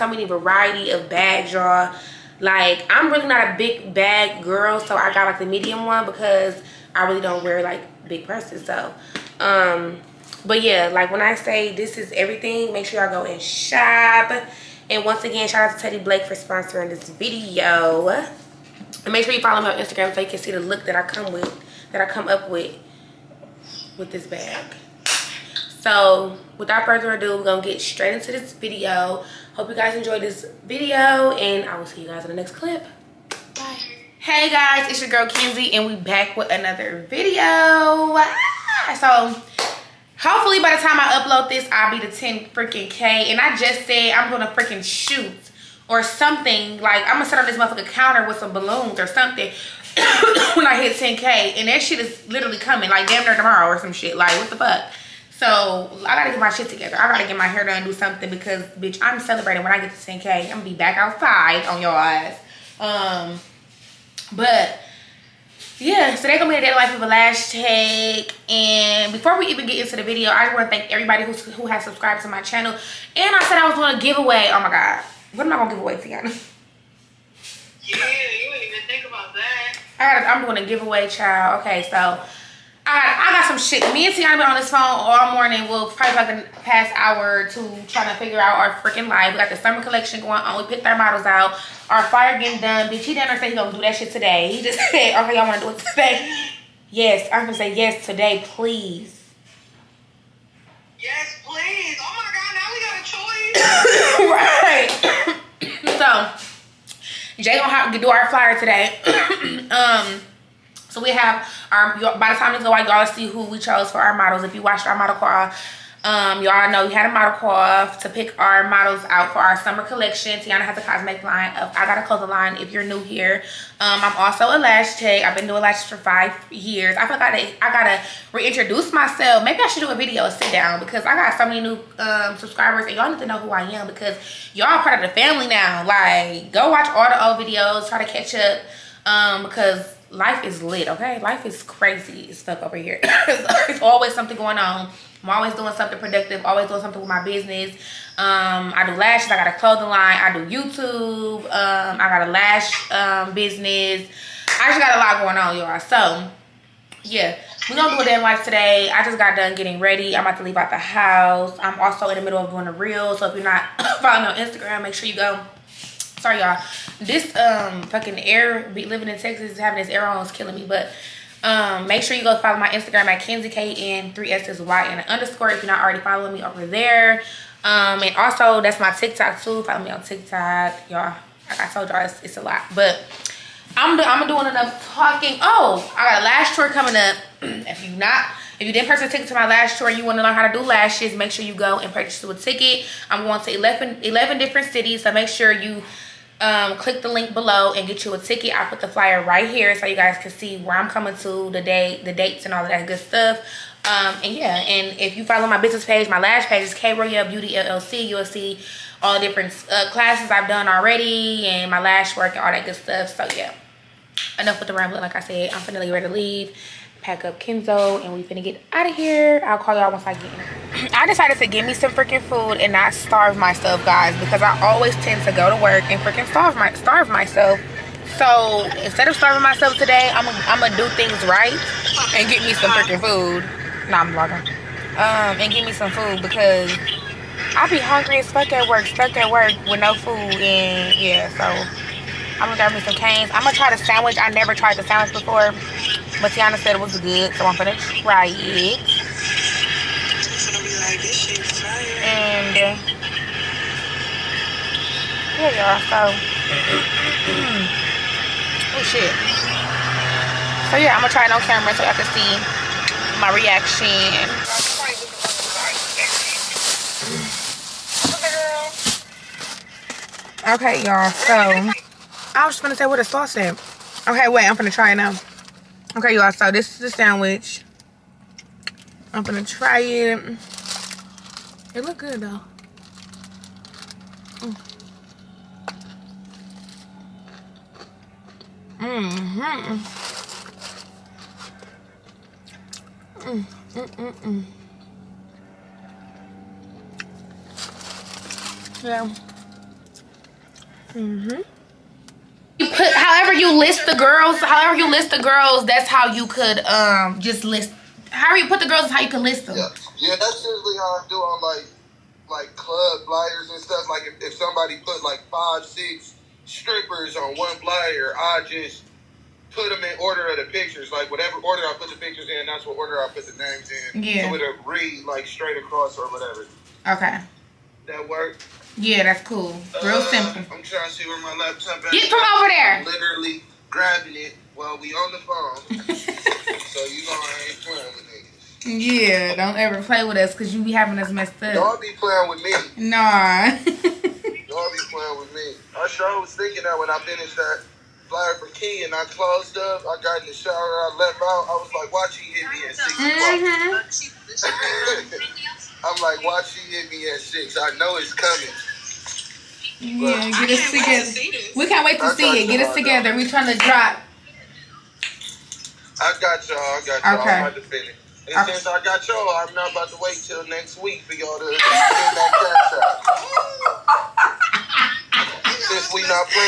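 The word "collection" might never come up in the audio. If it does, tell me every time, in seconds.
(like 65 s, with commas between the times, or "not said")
89 s, 119 s.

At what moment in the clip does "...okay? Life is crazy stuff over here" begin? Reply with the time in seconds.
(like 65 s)
140 s.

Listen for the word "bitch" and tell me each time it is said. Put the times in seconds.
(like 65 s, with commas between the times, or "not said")
58 s, 92 s.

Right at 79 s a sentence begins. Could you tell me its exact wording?
I gotta, I'm doing a giveaway, child.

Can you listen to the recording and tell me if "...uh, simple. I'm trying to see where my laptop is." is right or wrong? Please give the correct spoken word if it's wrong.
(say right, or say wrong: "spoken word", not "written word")
right.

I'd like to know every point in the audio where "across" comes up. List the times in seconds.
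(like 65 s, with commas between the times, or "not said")
325 s.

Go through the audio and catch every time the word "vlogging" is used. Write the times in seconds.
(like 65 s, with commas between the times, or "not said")
234 s.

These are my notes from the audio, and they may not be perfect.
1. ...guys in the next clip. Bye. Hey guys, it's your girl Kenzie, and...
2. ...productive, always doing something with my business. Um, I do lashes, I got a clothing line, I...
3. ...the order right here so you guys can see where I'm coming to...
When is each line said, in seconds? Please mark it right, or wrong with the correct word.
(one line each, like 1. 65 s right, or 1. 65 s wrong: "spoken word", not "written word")
1. 32 s right
2. 145 s right
3. 198 s wrong: "flyer", not "order".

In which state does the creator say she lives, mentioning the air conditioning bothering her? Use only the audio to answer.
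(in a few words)
Texas.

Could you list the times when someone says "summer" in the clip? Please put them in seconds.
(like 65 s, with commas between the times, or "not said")
89 s, 119 s.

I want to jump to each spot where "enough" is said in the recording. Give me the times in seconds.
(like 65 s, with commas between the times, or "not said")
184 s, 214 s.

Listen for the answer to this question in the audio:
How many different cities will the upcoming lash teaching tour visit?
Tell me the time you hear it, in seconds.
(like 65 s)
194 s.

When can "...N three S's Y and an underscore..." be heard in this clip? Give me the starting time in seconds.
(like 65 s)
173 s.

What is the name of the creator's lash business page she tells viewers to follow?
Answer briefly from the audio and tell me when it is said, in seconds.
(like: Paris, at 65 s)
K Beauty LLC, at 206 s.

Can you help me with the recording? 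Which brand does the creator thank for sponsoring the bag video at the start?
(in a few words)
Teddy Blake.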